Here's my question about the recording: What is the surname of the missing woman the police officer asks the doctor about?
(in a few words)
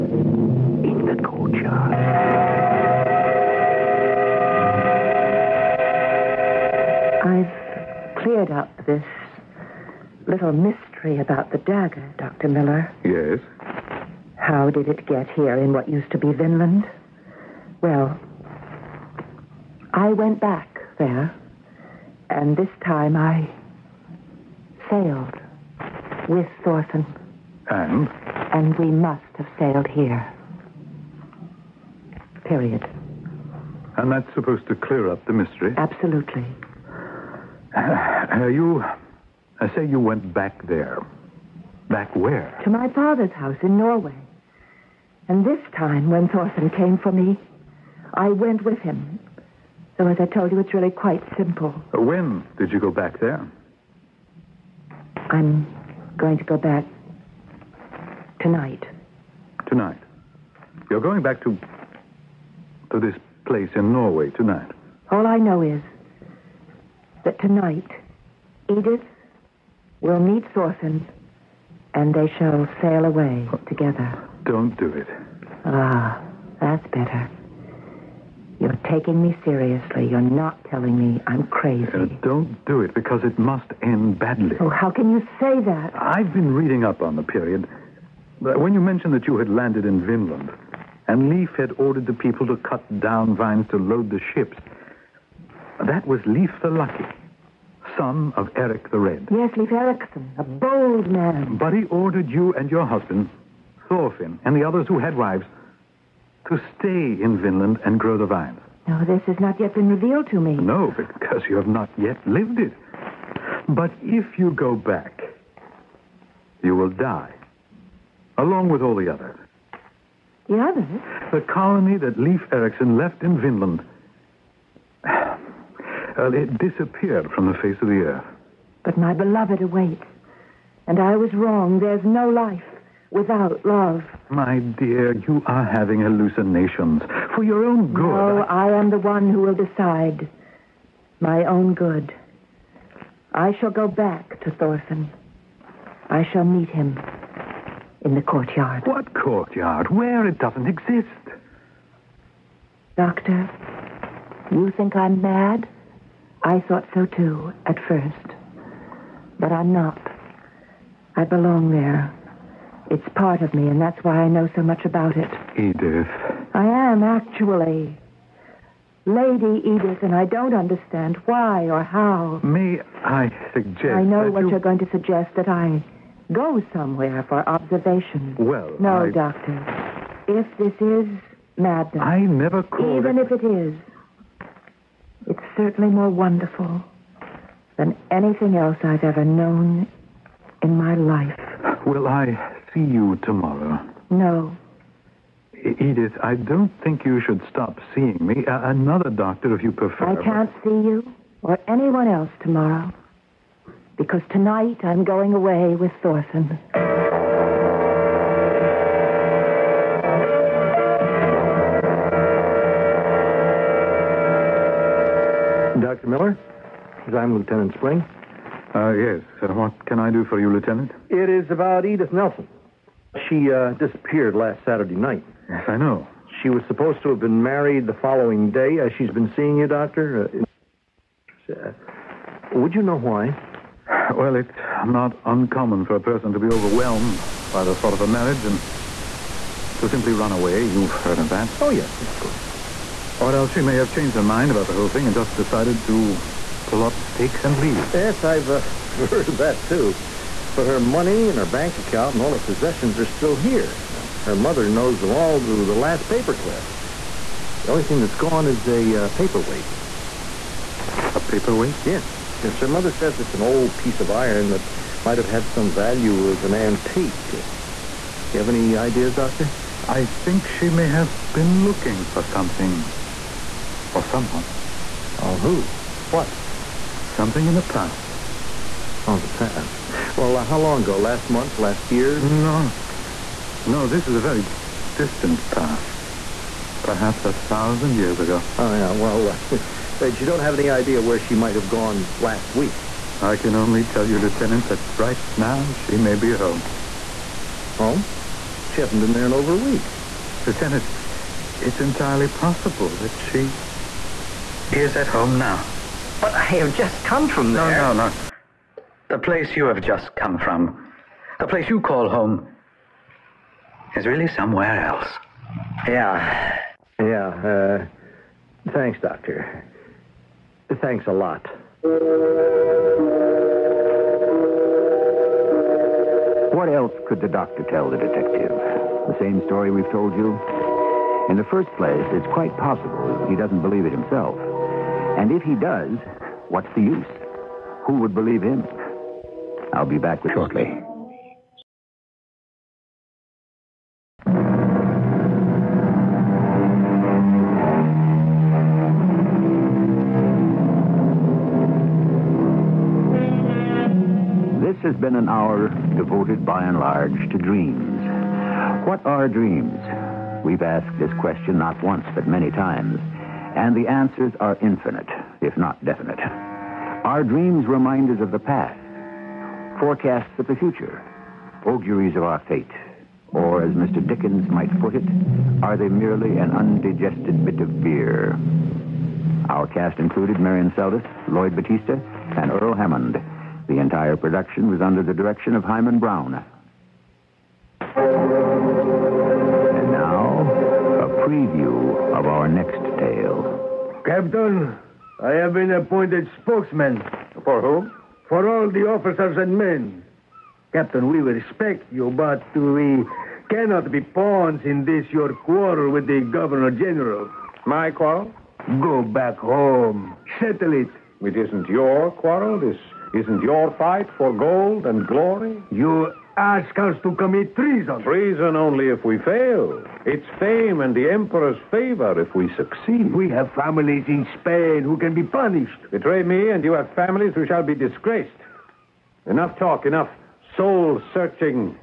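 Nelson.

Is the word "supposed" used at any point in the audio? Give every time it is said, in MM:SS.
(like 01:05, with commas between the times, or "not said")
00:34, 03:46.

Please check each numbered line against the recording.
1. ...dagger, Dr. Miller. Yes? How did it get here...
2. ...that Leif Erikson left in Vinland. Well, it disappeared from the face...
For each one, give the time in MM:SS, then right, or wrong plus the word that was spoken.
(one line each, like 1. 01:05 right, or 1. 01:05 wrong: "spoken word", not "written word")
1. 00:11 right
2. 02:01 right.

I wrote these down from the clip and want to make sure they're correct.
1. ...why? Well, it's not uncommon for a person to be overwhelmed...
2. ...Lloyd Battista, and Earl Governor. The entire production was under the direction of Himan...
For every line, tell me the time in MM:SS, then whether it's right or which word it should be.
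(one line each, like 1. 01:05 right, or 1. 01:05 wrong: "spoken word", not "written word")
1. 03:52 right
2. 06:21 wrong: "Hammond", not "Governor".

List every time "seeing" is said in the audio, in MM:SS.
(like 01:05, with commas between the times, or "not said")
03:17, 03:49.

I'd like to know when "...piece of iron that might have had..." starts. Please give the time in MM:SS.
04:23.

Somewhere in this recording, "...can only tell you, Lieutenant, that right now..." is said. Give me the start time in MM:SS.
04:53.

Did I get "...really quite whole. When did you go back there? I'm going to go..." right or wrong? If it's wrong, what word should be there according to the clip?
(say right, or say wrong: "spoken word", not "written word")
wrong: "simple", not "whole".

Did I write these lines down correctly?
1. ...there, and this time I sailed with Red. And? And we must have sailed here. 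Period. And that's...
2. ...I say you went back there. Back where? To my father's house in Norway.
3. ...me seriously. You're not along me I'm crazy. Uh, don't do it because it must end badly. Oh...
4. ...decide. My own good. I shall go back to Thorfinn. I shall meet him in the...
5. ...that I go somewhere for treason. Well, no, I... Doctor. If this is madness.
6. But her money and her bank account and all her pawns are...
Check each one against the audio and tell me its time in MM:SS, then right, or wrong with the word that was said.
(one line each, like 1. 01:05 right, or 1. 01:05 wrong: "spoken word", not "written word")
1. 00:20 wrong: "Thorfinn", not "Red"
2. 00:39 right
3. 01:19 wrong: "telling", not "along"
4. 02:19 right
5. 02:55 wrong: "observation", not "treason"
6. 04:10 wrong: "possessions", not "pawns".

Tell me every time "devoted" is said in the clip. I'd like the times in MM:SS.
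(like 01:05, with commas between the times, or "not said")
05:55.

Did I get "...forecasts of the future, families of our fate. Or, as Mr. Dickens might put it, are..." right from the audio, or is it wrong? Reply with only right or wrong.
wrong.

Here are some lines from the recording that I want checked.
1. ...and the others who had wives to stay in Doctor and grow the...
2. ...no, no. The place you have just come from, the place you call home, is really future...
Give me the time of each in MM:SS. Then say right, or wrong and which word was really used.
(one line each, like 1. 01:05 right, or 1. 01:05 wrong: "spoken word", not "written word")
1. 01:44 wrong: "Vinland", not "Doctor"
2. 05:07 wrong: "somewhere", not "future".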